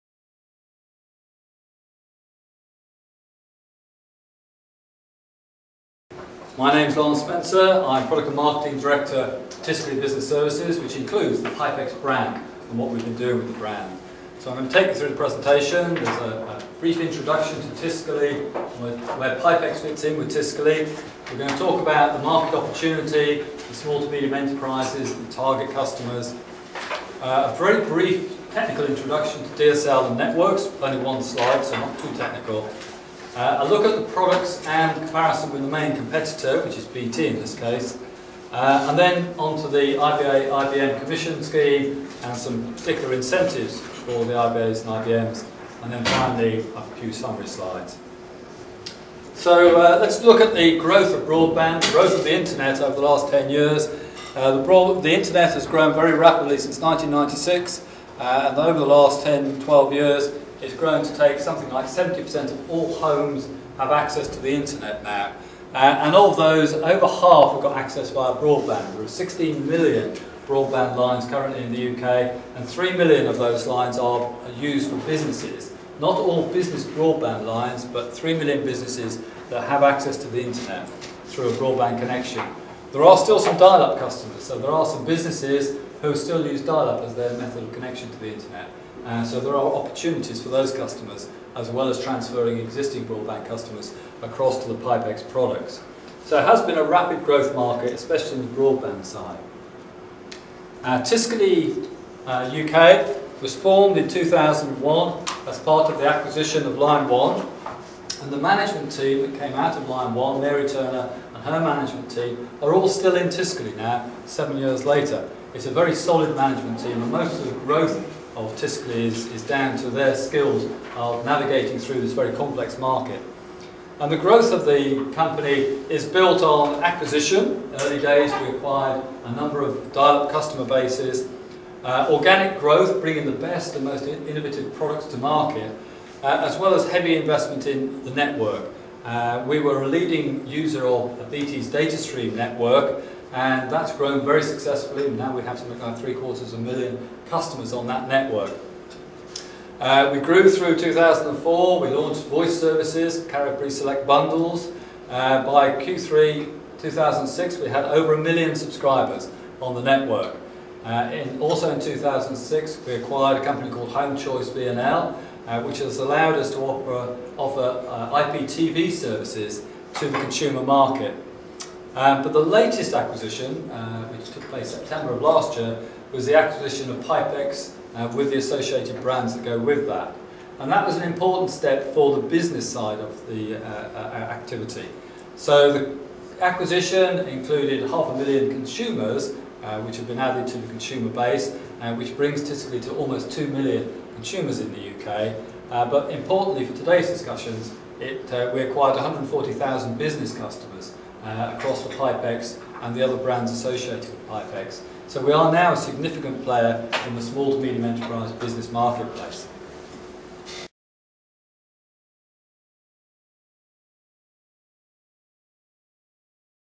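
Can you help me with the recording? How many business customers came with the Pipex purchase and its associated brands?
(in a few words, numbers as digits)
140,000.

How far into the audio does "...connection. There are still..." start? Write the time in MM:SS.
01:21.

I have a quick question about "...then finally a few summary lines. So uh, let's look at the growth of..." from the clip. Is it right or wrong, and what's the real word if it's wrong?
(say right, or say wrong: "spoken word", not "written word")
wrong: "slides", not "lines".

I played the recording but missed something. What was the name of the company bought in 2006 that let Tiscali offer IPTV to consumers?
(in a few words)
Home Choice VNL.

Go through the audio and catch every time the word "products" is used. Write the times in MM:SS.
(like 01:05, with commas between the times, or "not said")
00:08, 00:34, 01:35, 02:14.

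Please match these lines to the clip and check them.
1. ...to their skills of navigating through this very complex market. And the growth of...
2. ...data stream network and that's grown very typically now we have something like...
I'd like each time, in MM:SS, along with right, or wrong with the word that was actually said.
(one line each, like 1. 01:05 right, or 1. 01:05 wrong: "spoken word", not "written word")
1. 01:59 right
2. 02:21 wrong: "successfully", not "typically".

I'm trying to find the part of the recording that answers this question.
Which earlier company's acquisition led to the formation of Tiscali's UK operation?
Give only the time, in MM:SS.
01:46.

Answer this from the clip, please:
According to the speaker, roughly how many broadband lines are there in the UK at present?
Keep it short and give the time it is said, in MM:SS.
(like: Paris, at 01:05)
16 million, at 01:09.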